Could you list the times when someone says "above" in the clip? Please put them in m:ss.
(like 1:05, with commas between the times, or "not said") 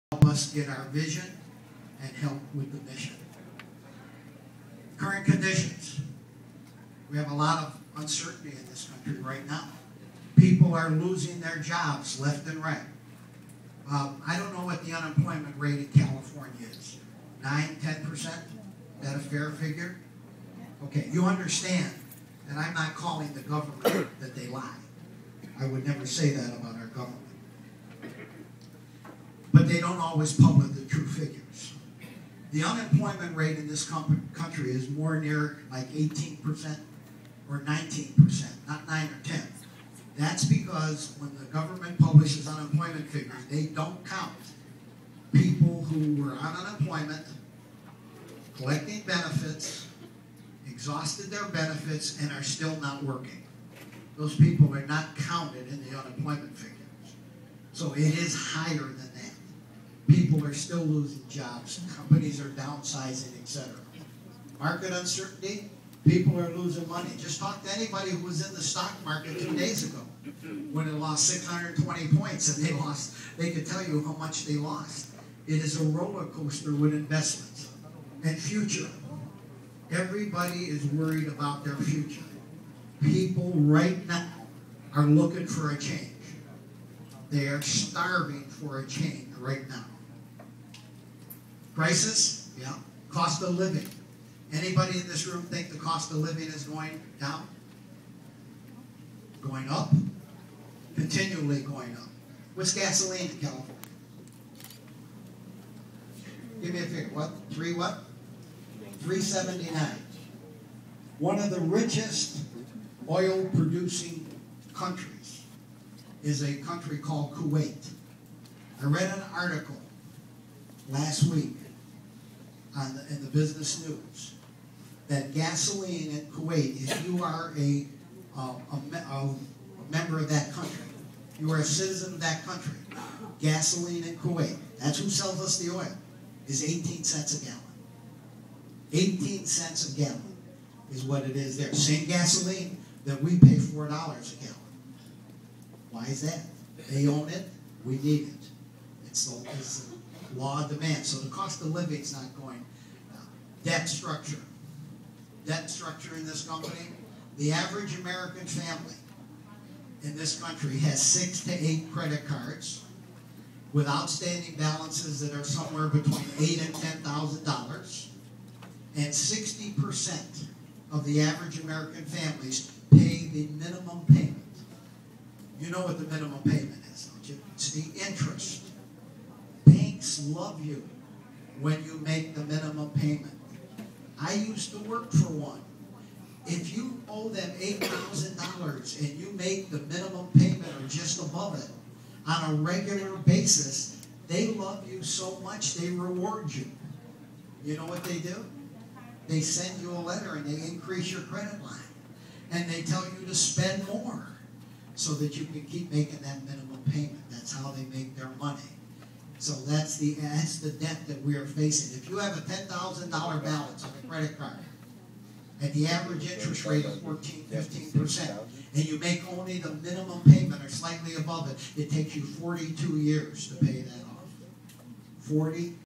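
3:11, 3:41.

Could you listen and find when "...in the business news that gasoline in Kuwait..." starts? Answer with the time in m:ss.
2:03.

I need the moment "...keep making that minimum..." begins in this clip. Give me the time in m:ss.
3:25.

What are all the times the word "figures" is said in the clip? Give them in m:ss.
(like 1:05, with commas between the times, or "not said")
0:19, 0:31, 0:43, 0:56, 1:46.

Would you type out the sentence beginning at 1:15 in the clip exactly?
It is a roller coaster with investments and future.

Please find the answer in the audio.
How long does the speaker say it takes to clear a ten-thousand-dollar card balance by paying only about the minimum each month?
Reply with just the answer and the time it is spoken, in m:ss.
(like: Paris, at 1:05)
42 years, at 3:42.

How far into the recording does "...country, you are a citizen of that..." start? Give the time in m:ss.
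2:10.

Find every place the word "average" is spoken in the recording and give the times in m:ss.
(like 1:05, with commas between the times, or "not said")
2:37, 2:51, 3:35.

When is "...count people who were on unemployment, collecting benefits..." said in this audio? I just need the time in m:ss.
0:44.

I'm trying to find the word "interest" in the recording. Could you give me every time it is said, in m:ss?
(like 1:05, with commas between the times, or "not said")
2:58, 3:36.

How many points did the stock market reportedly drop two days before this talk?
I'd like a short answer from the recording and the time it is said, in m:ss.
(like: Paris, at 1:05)
620, at 1:11.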